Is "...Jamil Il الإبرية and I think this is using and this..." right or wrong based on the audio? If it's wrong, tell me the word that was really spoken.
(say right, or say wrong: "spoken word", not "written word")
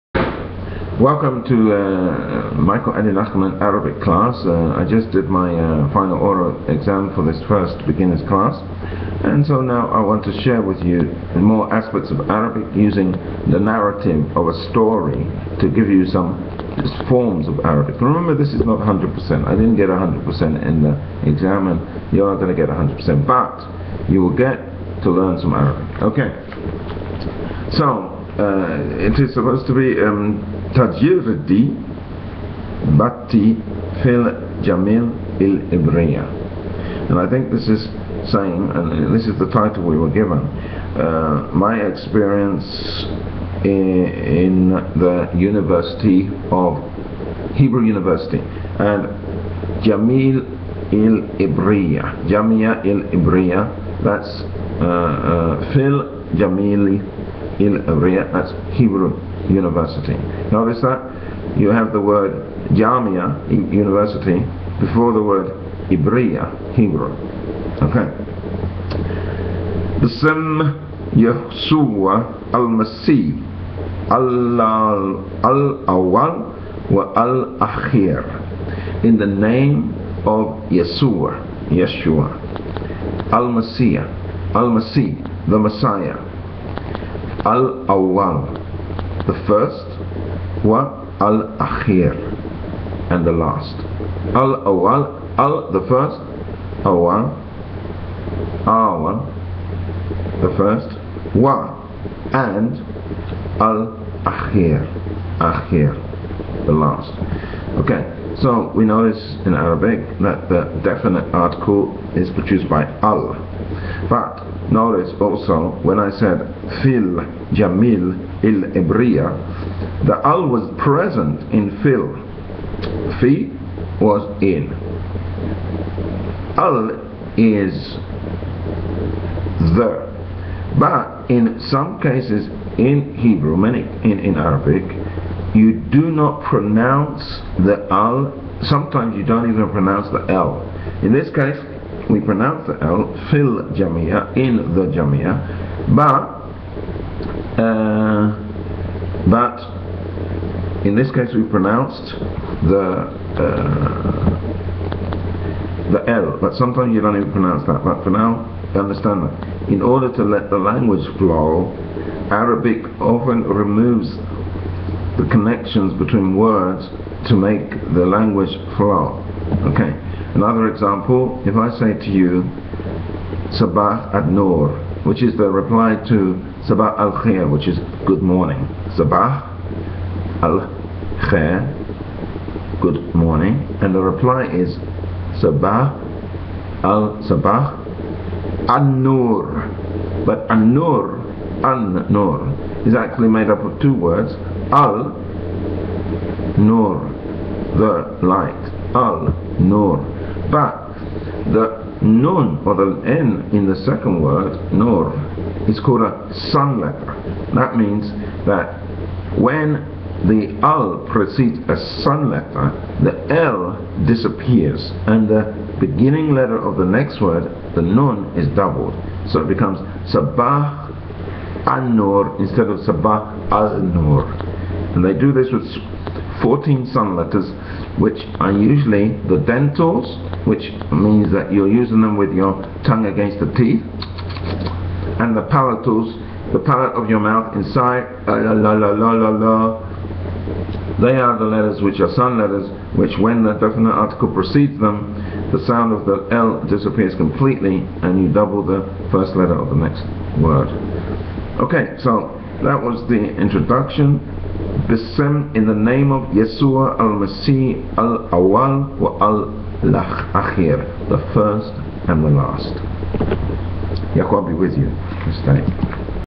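wrong: "saying", not "using".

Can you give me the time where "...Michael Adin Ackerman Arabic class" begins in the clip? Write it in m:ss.
0:02.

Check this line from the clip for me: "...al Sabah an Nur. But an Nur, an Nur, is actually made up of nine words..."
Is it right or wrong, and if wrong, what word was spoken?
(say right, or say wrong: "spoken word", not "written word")
wrong: "two", not "nine".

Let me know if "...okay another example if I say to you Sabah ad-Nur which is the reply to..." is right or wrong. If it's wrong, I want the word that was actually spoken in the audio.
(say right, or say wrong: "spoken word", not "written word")
right.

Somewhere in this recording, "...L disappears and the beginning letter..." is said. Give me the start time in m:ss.
3:33.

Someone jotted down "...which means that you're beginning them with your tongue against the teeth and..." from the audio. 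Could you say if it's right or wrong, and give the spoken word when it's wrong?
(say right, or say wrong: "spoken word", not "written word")
wrong: "using", not "beginning".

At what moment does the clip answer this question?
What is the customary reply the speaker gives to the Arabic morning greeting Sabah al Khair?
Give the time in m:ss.
3:40.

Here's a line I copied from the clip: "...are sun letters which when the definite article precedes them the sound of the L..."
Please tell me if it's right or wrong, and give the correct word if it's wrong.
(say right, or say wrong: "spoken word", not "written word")
right.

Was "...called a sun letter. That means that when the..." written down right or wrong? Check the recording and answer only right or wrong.
right.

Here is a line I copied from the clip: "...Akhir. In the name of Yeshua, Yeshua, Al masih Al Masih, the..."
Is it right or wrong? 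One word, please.
right.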